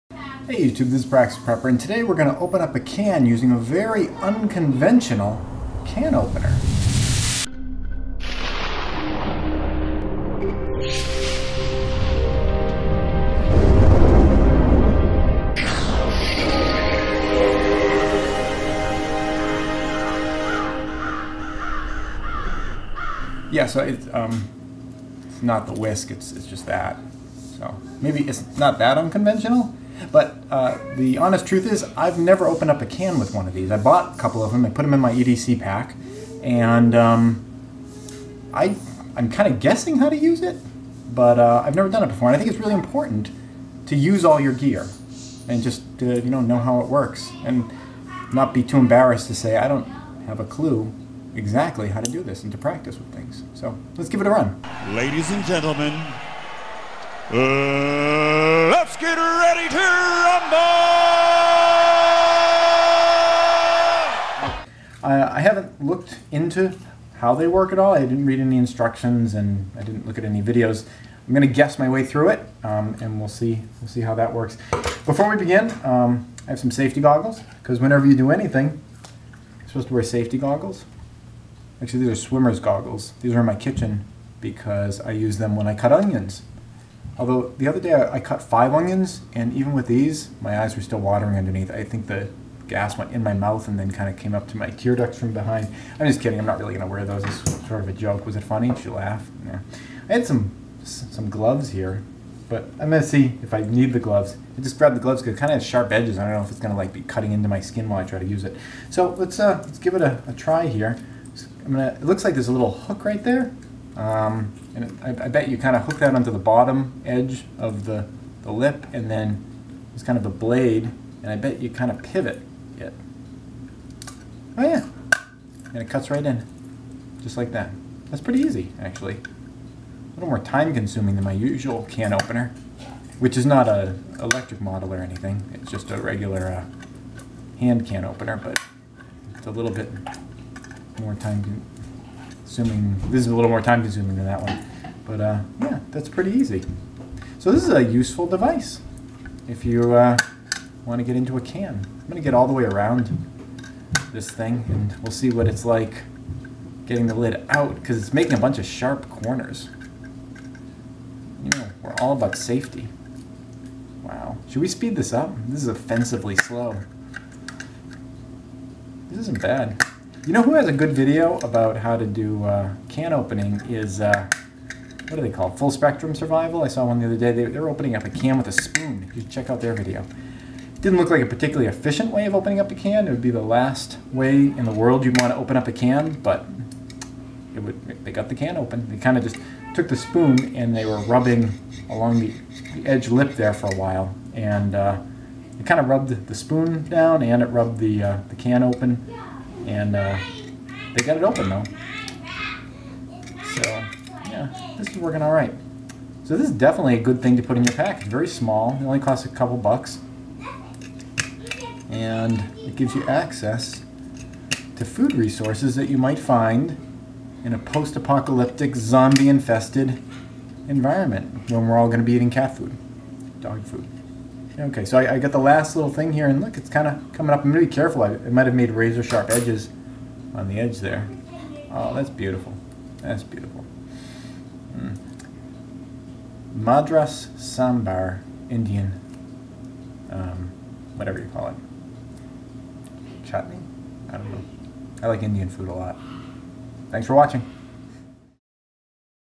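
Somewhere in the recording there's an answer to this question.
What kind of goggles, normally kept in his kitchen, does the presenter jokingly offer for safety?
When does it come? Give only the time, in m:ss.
1:22.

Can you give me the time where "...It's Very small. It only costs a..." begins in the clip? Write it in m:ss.
3:27.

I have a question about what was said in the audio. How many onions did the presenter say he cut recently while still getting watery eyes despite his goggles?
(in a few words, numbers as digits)
5.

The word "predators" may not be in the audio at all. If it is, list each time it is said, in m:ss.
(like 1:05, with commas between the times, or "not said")
not said.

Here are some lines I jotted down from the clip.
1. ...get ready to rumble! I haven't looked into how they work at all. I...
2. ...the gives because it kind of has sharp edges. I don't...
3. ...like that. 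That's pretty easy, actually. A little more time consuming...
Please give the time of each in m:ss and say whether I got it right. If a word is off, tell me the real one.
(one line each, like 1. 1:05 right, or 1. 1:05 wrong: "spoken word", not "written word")
1. 0:59 right
2. 1:44 wrong: "gloves", not "gives"
3. 2:07 right.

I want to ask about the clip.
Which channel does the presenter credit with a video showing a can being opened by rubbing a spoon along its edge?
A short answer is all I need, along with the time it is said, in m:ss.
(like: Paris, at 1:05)
Full Spectrum Survival, at 2:55.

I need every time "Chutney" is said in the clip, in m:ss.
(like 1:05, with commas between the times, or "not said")
4:03.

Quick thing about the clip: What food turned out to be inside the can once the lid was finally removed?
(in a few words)
Madras Sambar.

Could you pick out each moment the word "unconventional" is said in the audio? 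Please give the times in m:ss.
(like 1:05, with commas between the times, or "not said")
0:04, 0:28.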